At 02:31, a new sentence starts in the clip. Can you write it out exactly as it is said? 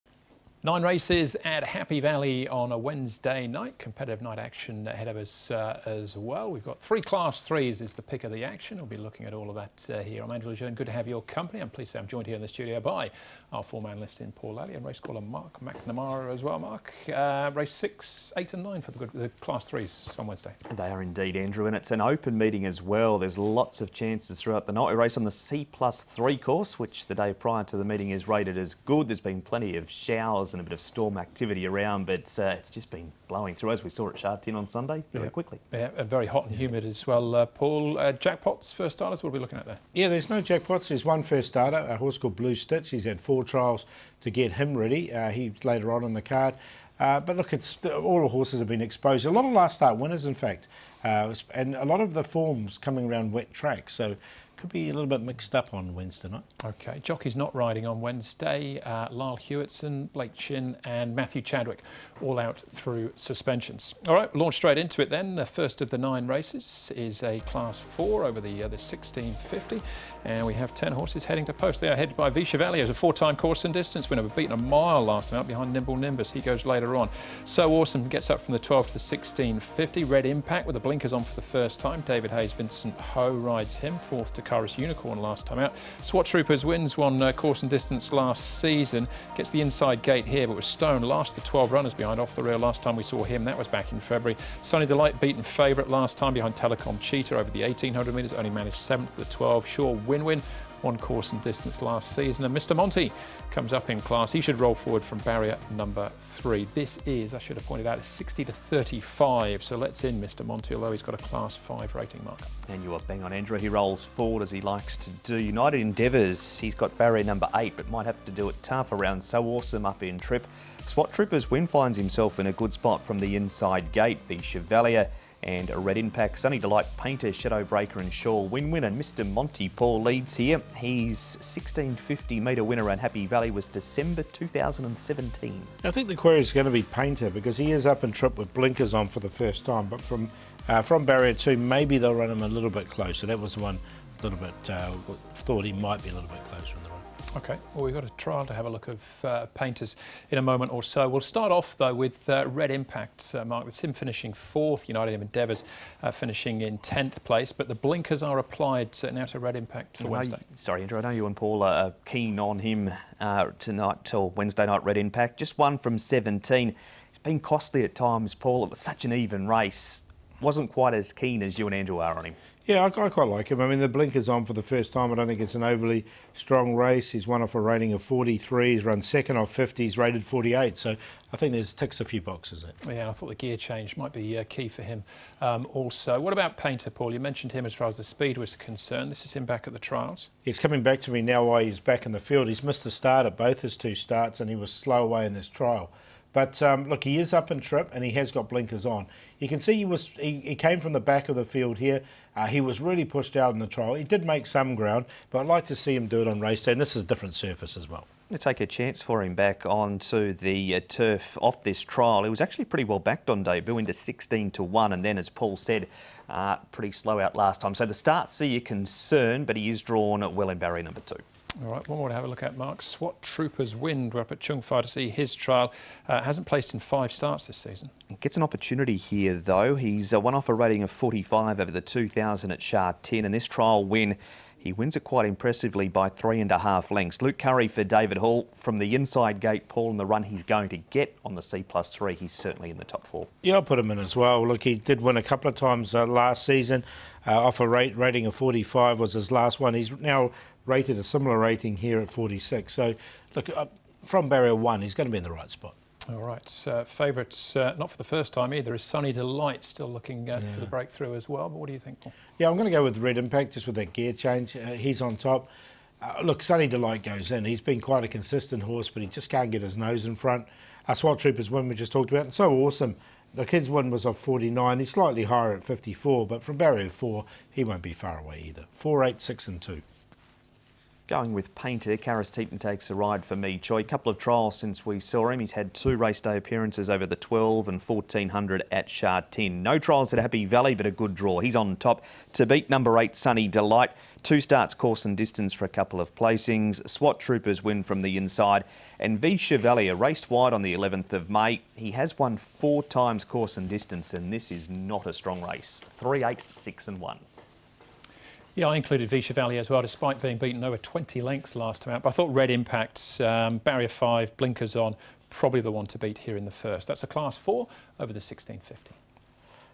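We'll start off, though, with uh, Red Impact, uh, Mark.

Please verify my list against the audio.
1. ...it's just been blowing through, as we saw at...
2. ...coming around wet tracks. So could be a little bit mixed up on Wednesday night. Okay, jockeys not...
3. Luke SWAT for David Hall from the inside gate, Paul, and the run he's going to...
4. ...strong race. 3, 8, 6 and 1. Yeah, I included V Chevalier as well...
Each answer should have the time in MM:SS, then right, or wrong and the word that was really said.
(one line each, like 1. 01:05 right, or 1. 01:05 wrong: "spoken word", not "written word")
1. 00:32 right
2. 00:52 right
3. 03:57 wrong: "Currie", not "SWAT"
4. 05:05 right.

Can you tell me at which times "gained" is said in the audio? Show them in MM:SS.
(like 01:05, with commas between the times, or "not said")
not said.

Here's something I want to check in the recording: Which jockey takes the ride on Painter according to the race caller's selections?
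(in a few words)
Karis Teetan.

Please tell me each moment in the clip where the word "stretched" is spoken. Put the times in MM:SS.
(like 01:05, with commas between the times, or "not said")
not said.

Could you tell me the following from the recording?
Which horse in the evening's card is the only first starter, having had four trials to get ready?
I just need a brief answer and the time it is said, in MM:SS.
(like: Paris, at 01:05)
Blue Stitch, at 00:42.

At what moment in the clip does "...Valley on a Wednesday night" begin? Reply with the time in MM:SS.
00:02.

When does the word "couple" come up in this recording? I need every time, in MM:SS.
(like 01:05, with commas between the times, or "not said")
04:05, 04:43, 04:55.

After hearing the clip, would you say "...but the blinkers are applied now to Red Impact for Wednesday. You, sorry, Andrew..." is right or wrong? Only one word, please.
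right.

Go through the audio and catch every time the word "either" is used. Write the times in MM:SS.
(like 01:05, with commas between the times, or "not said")
04:18, 04:38.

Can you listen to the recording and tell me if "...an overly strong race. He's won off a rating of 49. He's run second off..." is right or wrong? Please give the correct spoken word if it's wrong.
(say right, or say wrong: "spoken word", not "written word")
wrong: "43", not "49".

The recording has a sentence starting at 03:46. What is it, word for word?
Uh, hasn't placed in five starts this season.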